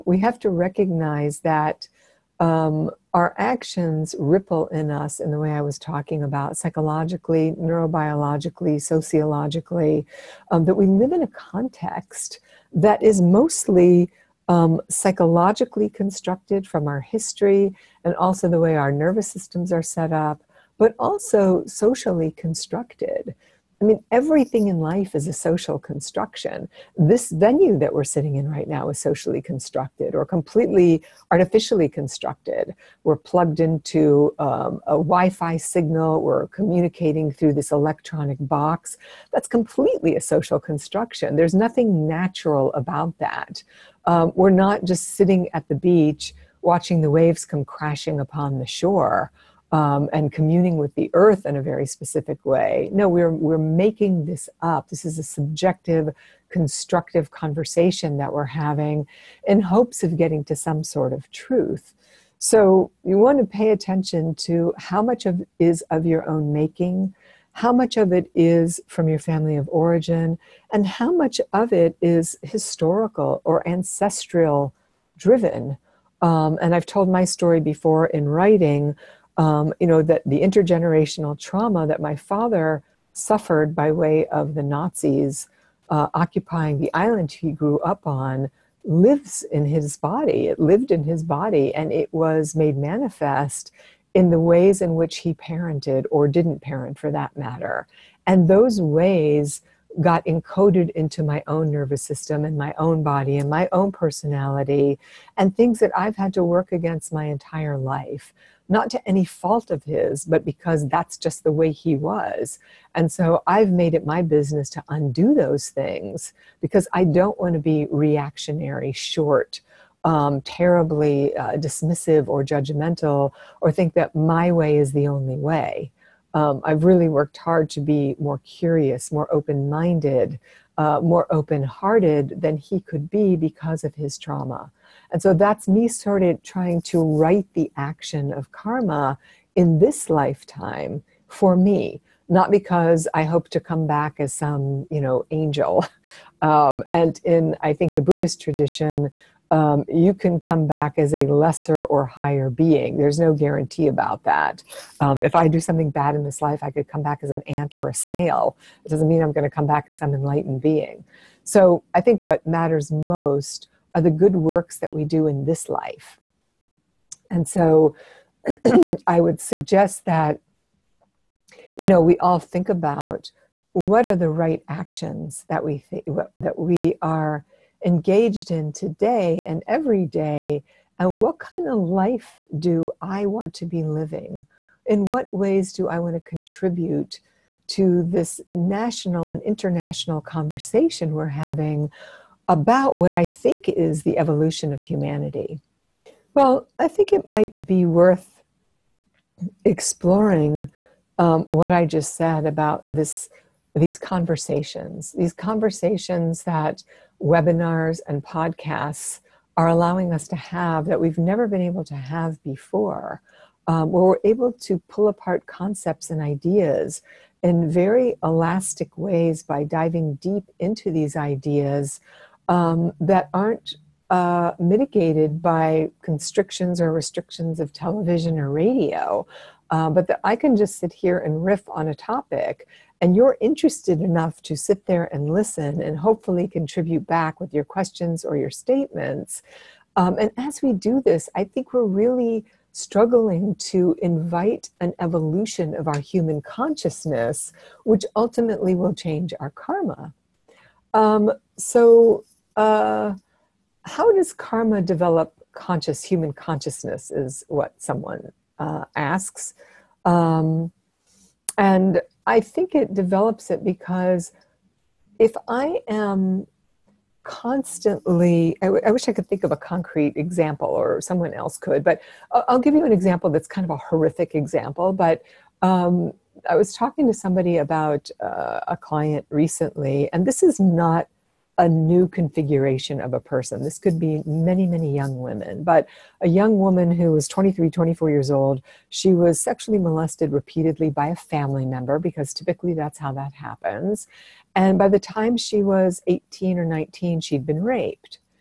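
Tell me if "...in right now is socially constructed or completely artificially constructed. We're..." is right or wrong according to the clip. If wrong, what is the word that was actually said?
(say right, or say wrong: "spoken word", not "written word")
right.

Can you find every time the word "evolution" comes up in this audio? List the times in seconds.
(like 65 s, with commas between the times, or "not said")
194 s, 244 s.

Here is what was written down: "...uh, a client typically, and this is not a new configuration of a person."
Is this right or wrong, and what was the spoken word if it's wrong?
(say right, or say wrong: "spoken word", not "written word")
wrong: "recently", not "typically".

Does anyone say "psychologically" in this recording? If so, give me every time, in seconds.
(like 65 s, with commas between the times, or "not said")
6 s, 14 s.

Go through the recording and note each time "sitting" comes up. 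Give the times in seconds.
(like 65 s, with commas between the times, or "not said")
28 s, 45 s.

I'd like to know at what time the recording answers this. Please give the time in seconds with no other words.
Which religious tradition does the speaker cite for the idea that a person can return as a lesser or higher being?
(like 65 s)
148 s.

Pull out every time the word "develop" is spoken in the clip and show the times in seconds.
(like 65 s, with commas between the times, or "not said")
254 s, 262 s.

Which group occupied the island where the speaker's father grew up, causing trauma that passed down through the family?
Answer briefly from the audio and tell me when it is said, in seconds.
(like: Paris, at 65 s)
The Nazis, at 84 s.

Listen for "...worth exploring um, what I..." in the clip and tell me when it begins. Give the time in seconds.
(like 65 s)
197 s.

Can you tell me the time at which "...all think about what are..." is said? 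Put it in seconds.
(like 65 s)
172 s.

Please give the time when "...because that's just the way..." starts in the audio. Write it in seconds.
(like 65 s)
110 s.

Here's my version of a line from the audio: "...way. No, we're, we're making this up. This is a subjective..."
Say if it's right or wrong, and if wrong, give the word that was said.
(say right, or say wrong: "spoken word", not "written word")
right.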